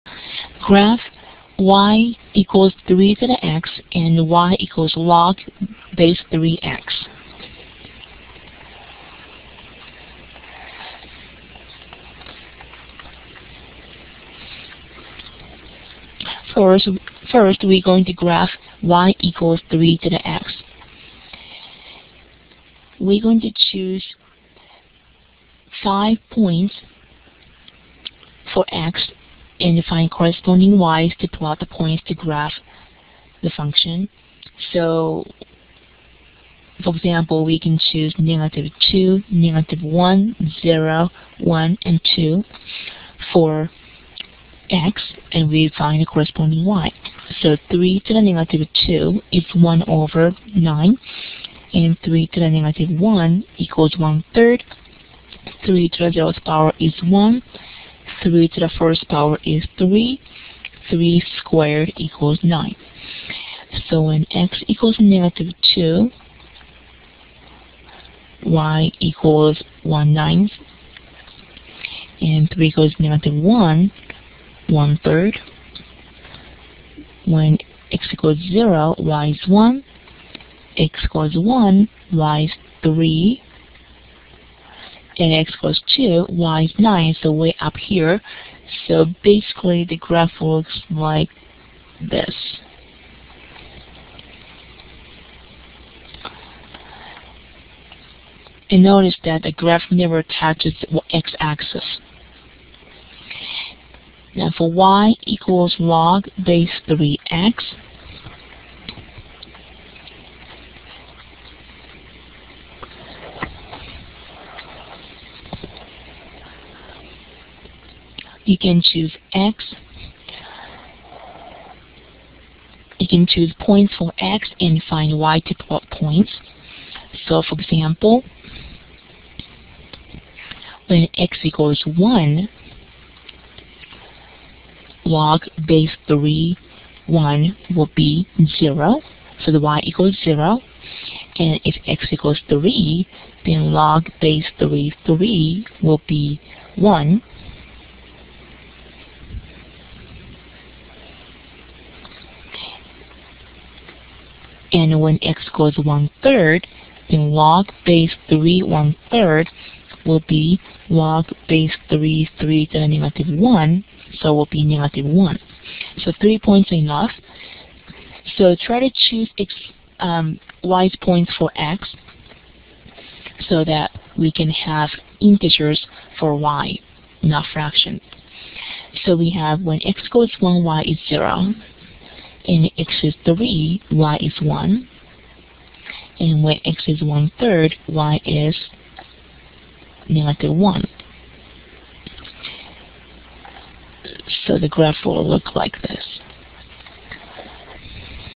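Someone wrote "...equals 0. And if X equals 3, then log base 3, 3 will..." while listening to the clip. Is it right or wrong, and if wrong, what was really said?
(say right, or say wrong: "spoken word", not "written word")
right.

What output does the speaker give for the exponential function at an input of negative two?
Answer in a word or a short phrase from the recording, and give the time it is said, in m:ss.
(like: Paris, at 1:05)
1/9, at 0:49.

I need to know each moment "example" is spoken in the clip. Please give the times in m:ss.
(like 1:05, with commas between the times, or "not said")
0:36, 2:07.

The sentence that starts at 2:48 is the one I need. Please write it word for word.
So try to choose x, um, points for x so that we can have integers for y, not fractions.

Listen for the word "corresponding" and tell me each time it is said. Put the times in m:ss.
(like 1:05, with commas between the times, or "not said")
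0:30, 0:46.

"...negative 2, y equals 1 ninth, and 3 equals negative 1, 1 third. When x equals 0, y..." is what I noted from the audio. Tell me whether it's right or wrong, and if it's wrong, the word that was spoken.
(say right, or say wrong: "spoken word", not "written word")
right.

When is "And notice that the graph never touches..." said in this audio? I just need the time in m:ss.
1:38.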